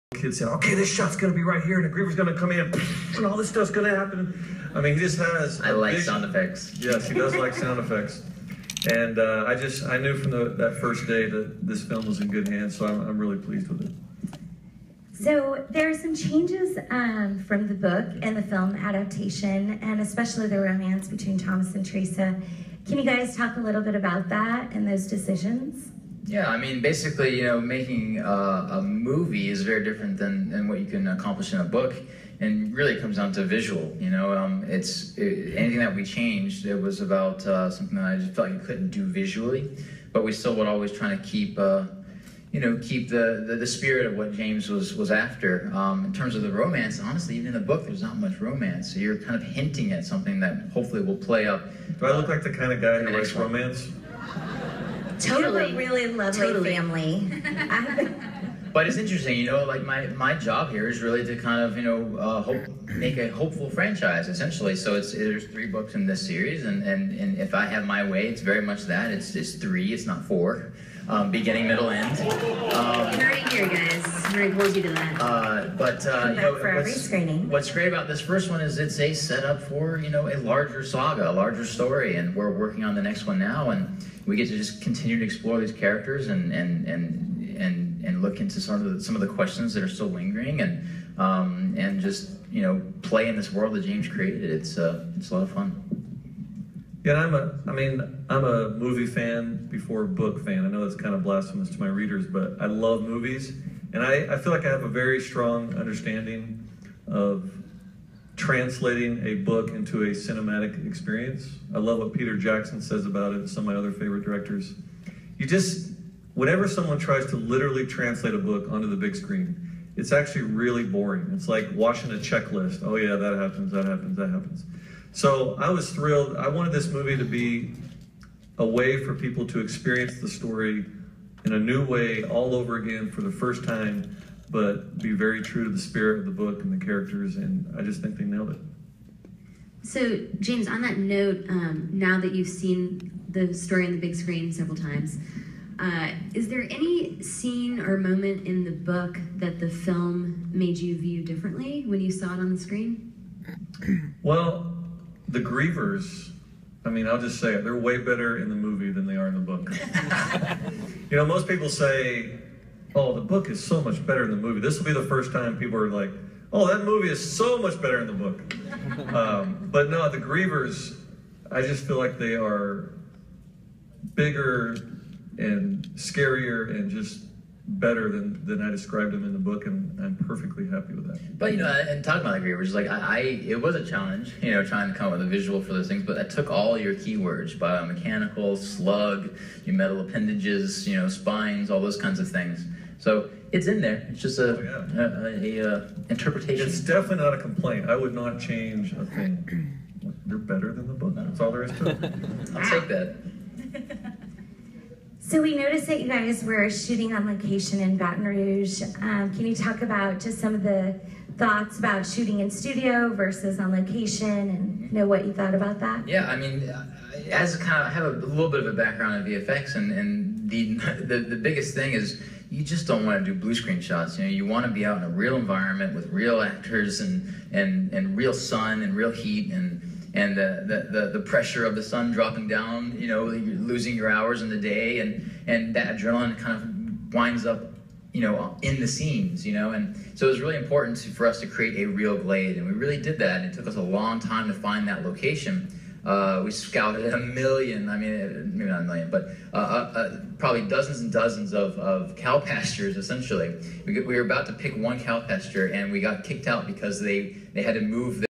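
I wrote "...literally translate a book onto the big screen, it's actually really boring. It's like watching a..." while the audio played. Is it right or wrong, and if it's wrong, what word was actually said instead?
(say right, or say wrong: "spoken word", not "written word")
right.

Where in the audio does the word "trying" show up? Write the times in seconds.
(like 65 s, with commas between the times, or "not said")
40 s, 184 s.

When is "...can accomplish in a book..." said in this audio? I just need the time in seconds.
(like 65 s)
30 s.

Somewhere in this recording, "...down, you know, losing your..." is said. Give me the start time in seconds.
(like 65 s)
232 s.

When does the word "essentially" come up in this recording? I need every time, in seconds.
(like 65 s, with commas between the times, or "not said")
64 s, 252 s.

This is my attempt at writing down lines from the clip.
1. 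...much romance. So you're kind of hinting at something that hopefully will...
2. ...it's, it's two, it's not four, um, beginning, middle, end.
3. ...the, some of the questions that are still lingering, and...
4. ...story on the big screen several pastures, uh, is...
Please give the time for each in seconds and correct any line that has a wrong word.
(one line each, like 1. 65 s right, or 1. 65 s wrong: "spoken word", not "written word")
1. 48 s right
2. 69 s wrong: "three", not "two"
3. 88 s right
4. 143 s wrong: "times", not "pastures".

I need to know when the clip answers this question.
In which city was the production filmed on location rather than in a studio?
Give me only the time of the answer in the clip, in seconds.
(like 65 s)
207 s.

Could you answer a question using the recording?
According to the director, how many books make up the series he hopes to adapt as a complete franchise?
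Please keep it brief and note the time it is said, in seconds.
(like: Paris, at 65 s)
3, at 65 s.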